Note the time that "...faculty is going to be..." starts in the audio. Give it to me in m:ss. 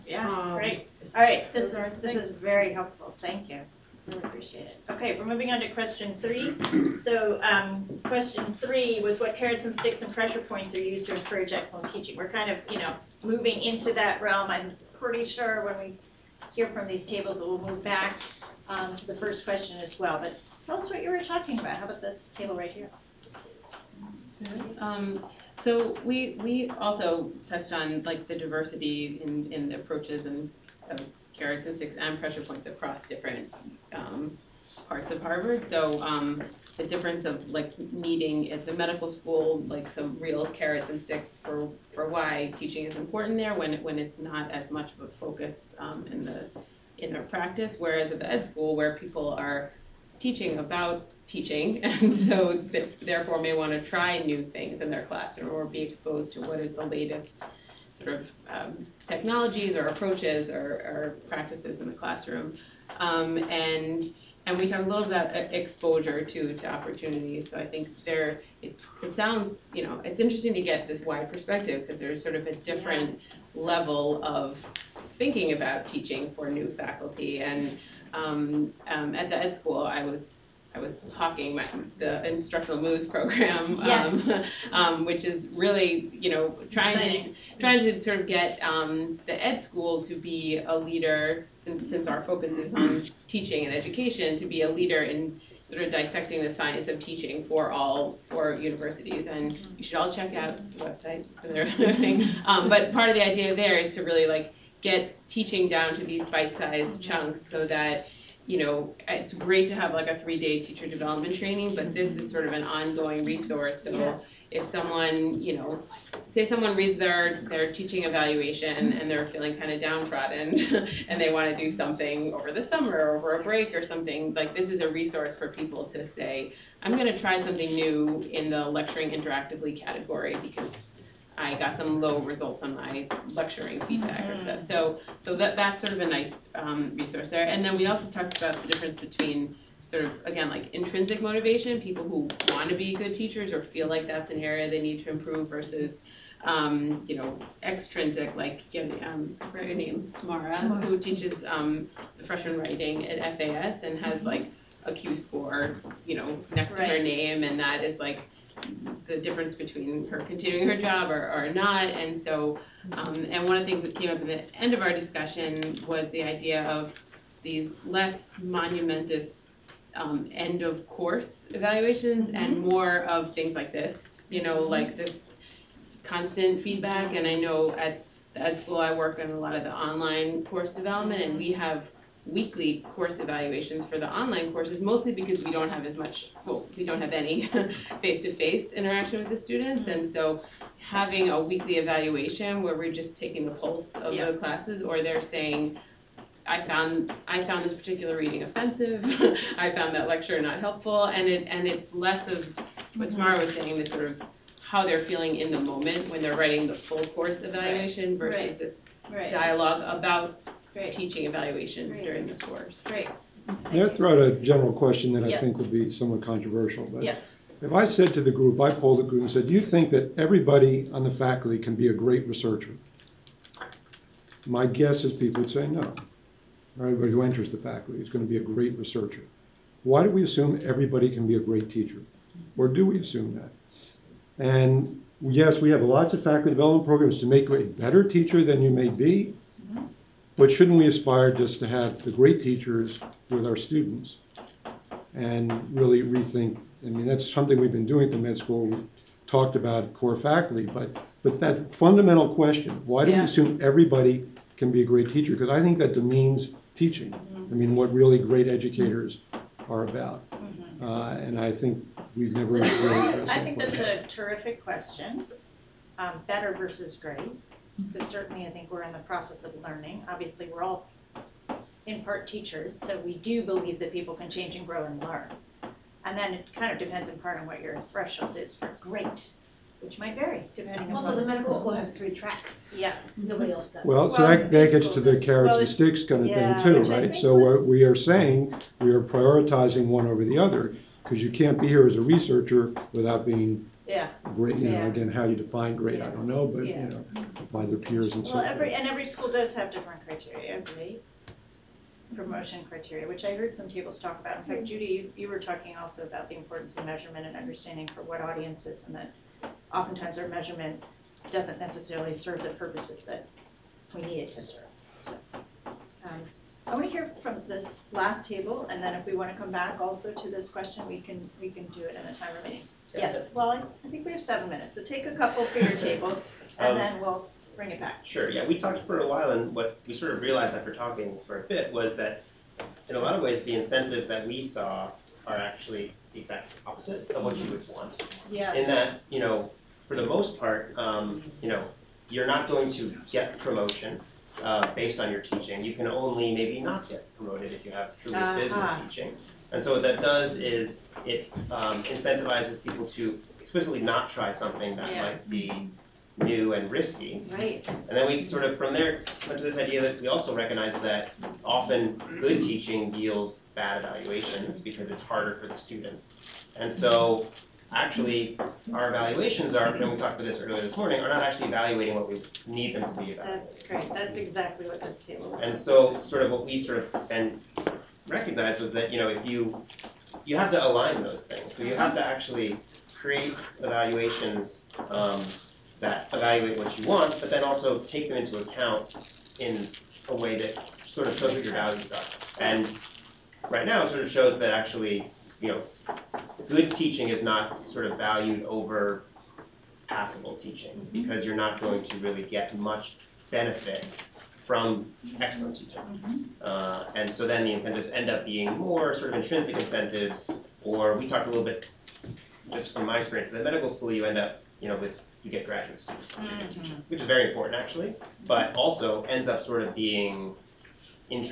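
3:47.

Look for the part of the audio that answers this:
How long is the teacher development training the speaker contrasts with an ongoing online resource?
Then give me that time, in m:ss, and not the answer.
1:50.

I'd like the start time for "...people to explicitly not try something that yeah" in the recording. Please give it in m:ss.
5:52.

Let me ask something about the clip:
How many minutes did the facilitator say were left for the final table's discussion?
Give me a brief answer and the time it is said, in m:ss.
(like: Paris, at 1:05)
7, at 5:24.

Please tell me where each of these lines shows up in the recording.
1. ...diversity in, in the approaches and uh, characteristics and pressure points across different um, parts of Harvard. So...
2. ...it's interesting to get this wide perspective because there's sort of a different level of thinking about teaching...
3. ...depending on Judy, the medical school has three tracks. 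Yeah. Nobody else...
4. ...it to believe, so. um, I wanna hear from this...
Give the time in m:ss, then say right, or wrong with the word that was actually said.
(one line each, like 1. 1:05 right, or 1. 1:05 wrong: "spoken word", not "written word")
1. 0:28 right
2. 1:10 right
3. 4:40 wrong: "Also", not "Judy"
4. 5:14 wrong: "serve", not "believe".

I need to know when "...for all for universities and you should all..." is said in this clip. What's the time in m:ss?
1:37.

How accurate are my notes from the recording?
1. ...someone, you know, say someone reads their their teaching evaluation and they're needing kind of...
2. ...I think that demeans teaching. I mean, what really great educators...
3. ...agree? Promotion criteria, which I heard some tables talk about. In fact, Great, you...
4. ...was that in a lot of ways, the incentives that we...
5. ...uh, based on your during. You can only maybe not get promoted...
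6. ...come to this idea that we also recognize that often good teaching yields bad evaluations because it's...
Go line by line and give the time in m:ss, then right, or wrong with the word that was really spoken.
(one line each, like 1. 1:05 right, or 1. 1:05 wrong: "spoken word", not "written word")
1. 1:54 wrong: "feeling", not "needing"
2. 4:15 right
3. 5:00 wrong: "Judy", not "Great"
4. 5:31 right
5. 5:44 wrong: "teaching", not "during"
6. 5:59 right.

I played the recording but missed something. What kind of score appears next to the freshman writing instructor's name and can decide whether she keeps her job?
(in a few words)
Q score.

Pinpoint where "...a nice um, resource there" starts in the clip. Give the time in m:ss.
2:15.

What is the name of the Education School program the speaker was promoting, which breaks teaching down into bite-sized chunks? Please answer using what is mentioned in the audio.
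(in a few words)
instructional moves program.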